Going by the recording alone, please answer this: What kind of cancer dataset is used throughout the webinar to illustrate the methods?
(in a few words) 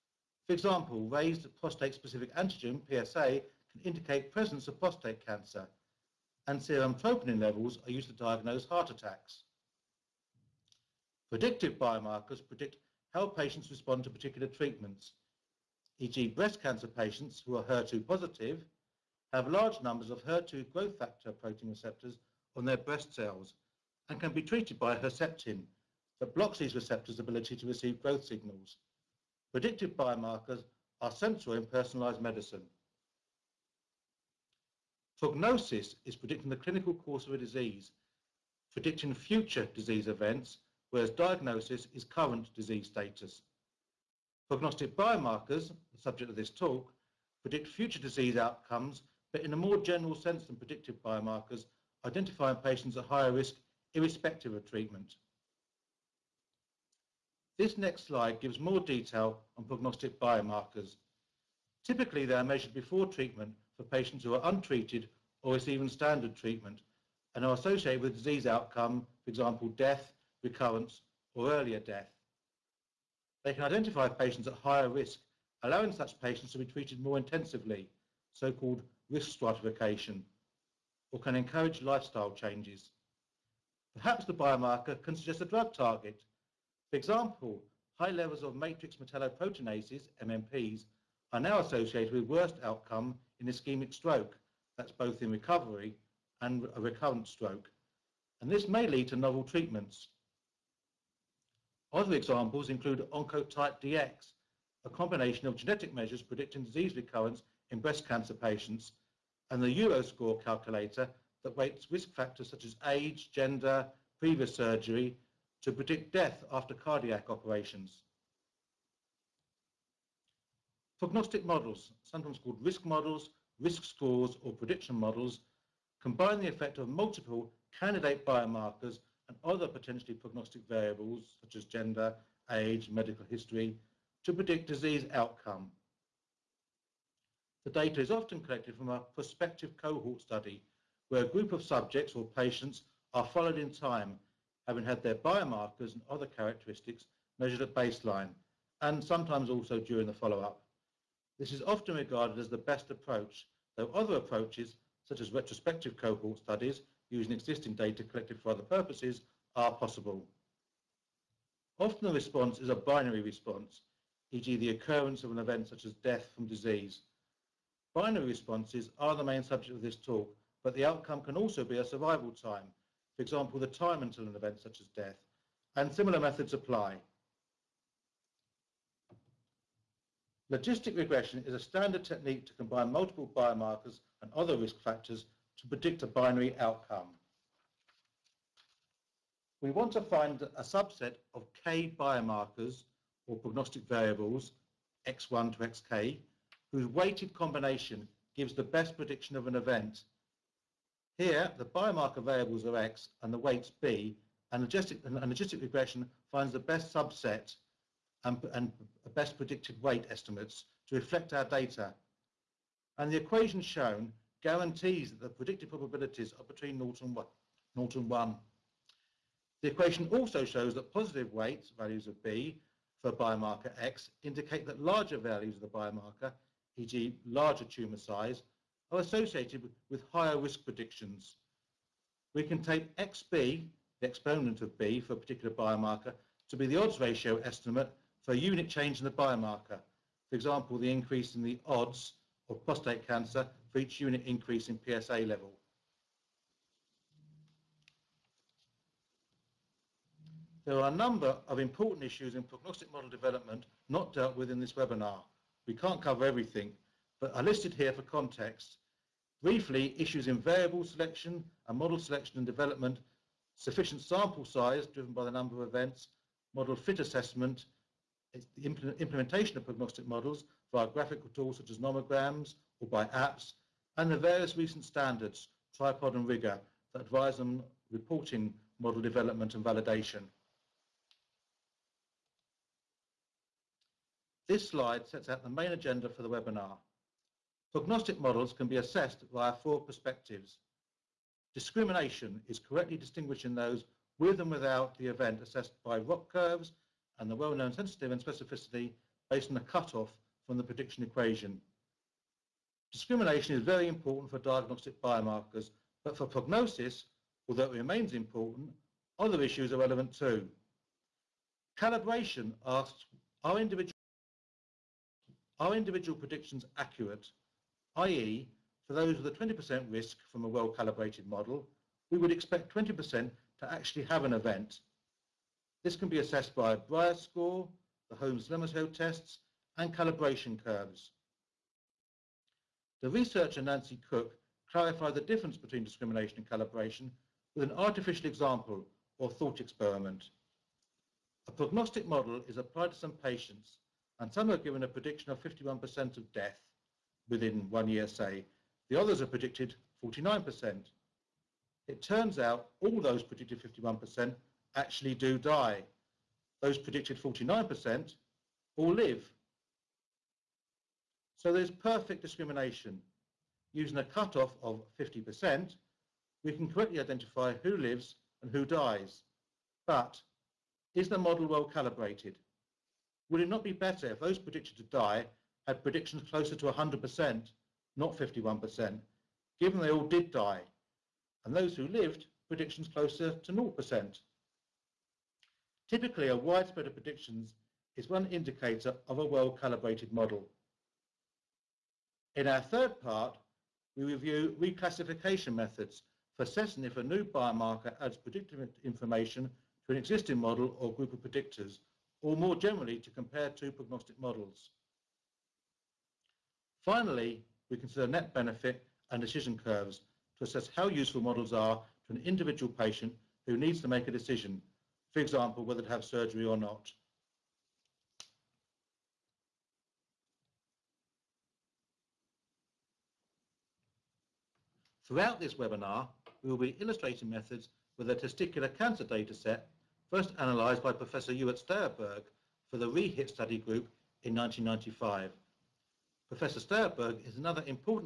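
testicular cancer.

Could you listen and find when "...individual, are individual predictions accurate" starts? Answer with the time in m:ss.
5:13.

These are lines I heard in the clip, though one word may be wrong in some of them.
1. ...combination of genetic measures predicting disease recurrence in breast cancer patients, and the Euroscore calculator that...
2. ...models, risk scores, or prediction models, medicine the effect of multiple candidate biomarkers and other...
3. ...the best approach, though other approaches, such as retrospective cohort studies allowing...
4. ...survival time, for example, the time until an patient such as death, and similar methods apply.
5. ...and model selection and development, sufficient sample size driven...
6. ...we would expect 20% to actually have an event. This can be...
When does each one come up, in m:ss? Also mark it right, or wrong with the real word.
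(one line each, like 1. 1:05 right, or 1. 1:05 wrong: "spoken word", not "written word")
1. 1:44 right
2. 2:02 wrong: "combine", not "medicine"
3. 2:32 wrong: "using", not "allowing"
4. 2:51 wrong: "event", not "patient"
5. 4:21 right
6. 5:22 right.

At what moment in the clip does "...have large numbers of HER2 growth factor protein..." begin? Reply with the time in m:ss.
0:19.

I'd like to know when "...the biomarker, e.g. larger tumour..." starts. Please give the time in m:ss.
3:45.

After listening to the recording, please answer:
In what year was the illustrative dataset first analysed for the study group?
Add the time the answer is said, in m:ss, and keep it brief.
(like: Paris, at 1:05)
1995, at 7:14.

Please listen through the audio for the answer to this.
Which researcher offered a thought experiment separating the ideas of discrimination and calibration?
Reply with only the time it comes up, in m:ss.
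5:33.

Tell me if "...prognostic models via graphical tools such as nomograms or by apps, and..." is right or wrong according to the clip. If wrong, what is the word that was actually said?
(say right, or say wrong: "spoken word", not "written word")
right.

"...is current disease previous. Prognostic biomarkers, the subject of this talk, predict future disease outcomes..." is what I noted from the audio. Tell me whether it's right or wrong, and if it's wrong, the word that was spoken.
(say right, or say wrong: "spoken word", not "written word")
wrong: "status", not "previous".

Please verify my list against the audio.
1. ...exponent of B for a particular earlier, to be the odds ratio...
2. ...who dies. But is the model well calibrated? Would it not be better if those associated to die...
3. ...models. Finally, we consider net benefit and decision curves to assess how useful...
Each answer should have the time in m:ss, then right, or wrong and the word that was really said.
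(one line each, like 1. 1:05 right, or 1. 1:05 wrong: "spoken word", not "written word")
1. 3:54 wrong: "biomarker", not "earlier"
2. 6:08 wrong: "predicted", not "associated"
3. 6:44 right.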